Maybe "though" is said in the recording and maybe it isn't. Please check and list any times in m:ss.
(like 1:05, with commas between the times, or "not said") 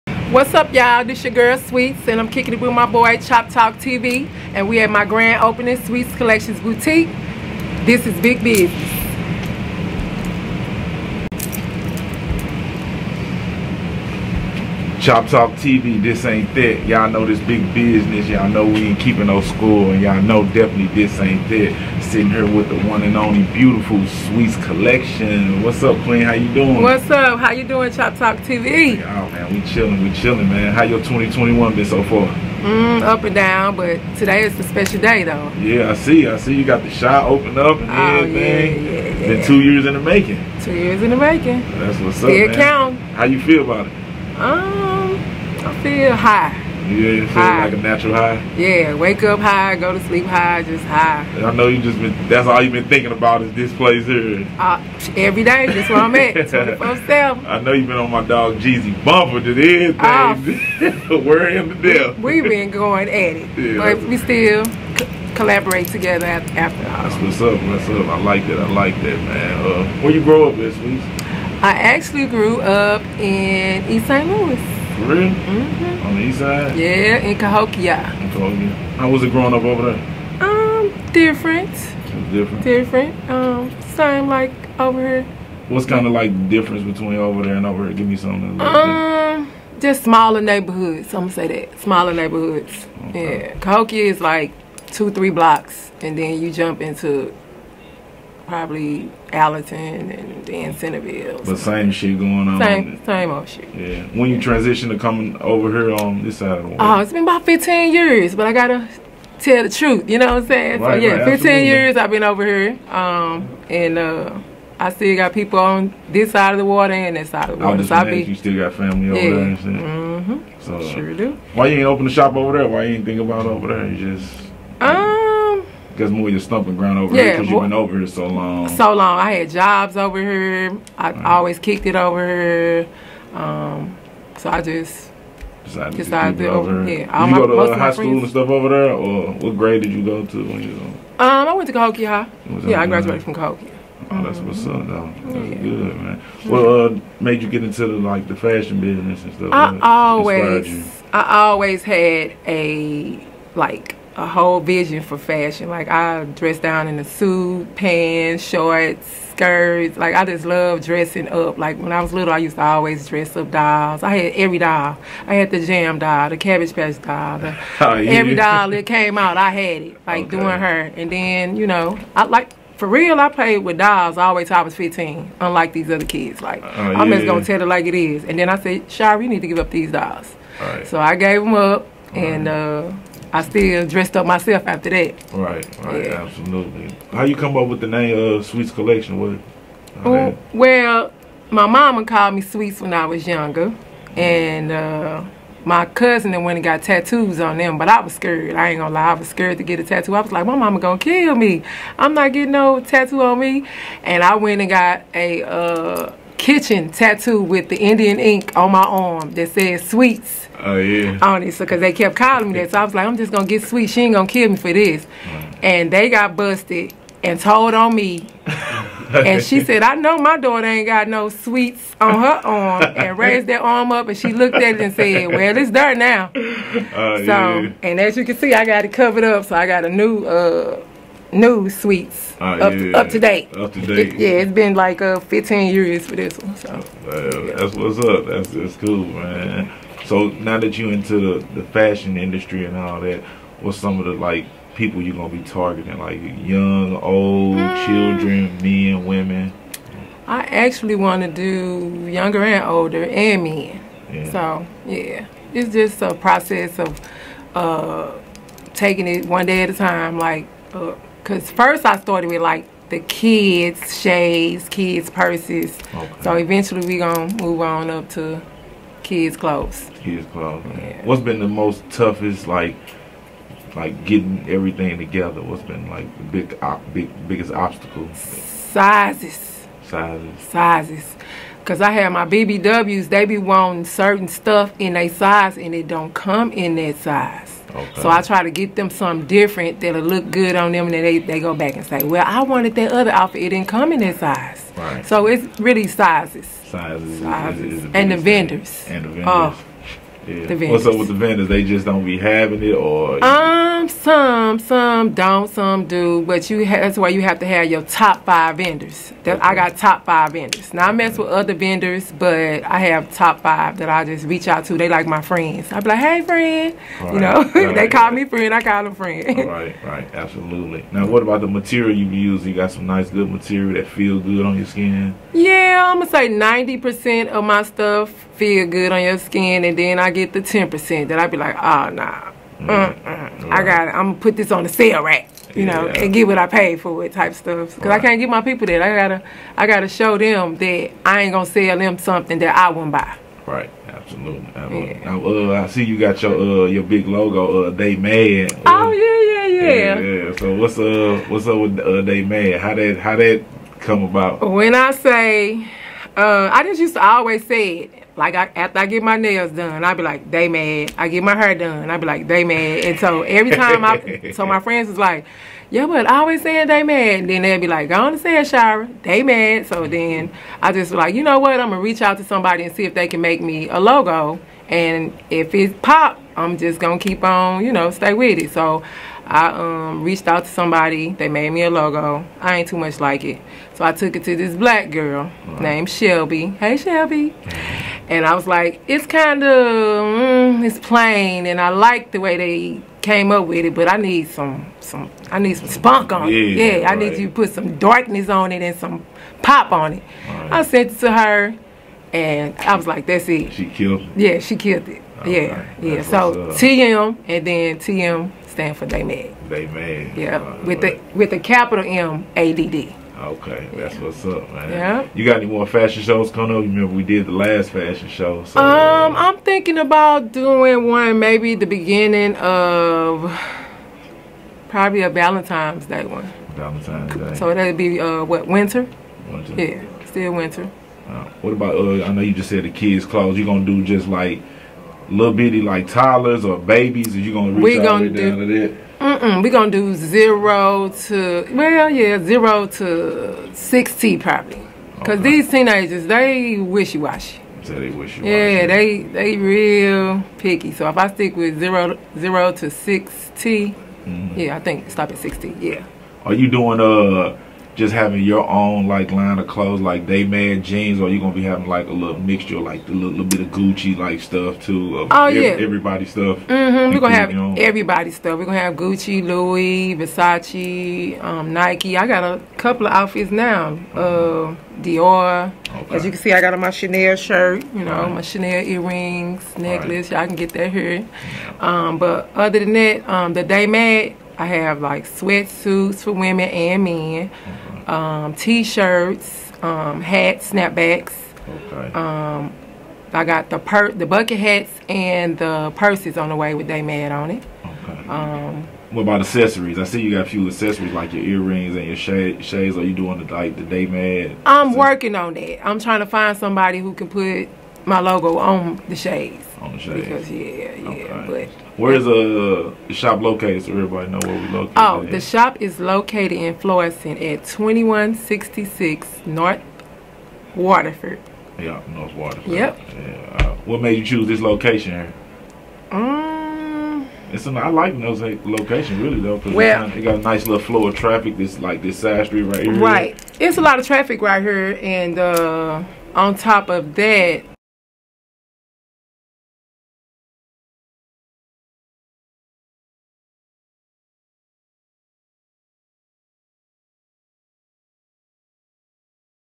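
0:35, 2:24, 8:49.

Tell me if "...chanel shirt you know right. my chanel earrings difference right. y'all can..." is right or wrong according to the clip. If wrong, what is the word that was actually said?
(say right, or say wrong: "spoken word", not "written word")
wrong: "necklace", not "difference".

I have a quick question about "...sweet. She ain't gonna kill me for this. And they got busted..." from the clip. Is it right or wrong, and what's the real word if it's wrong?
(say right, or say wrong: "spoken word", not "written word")
right.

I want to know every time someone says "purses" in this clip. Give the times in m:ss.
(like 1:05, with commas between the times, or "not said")
4:25, 8:15.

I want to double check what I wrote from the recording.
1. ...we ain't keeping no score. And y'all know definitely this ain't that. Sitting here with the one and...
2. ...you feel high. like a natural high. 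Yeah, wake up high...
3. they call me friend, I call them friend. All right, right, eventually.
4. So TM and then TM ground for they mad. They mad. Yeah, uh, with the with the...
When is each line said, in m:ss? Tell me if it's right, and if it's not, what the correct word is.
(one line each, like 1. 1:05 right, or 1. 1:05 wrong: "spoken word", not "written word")
1. 0:18 right
2. 0:46 right
3. 5:17 wrong: "absolutely", not "eventually"
4. 6:46 wrong: "stand", not "ground".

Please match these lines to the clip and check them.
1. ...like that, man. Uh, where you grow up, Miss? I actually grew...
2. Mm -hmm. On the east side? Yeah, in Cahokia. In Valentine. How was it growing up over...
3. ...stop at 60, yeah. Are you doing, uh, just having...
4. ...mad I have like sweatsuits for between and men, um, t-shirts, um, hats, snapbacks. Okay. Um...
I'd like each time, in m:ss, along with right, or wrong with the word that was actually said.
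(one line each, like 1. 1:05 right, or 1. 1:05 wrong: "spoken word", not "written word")
1. 1:08 right
2. 1:15 wrong: "Cahokia", not "Valentine"
3. 7:34 right
4. 8:03 wrong: "women", not "between".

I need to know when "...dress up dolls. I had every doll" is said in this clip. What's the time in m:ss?
2:43.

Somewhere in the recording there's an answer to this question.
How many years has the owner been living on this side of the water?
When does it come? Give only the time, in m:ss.
1:51.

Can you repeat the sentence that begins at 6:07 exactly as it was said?
And then they'd be like, go on and say it, They mad.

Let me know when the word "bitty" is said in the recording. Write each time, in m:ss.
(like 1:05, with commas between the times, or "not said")
7:15.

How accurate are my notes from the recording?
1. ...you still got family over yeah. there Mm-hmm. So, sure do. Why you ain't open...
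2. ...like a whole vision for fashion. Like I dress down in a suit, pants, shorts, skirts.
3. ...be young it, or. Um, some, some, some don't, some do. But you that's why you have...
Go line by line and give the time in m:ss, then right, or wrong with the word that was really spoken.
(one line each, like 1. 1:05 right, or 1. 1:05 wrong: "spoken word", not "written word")
1. 1:58 right
2. 2:33 right
3. 5:02 wrong: "having", not "young".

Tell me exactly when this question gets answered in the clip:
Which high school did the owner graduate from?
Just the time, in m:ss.
2:21.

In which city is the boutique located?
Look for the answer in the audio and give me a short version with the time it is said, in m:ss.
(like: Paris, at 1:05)
Florissant, at 8:36.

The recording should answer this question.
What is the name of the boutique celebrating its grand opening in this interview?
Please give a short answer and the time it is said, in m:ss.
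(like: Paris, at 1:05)
Sweets Collections Boutique, at 0:05.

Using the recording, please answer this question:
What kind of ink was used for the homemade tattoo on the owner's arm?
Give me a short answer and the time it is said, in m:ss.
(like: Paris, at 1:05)
Indian ink, at 3:27.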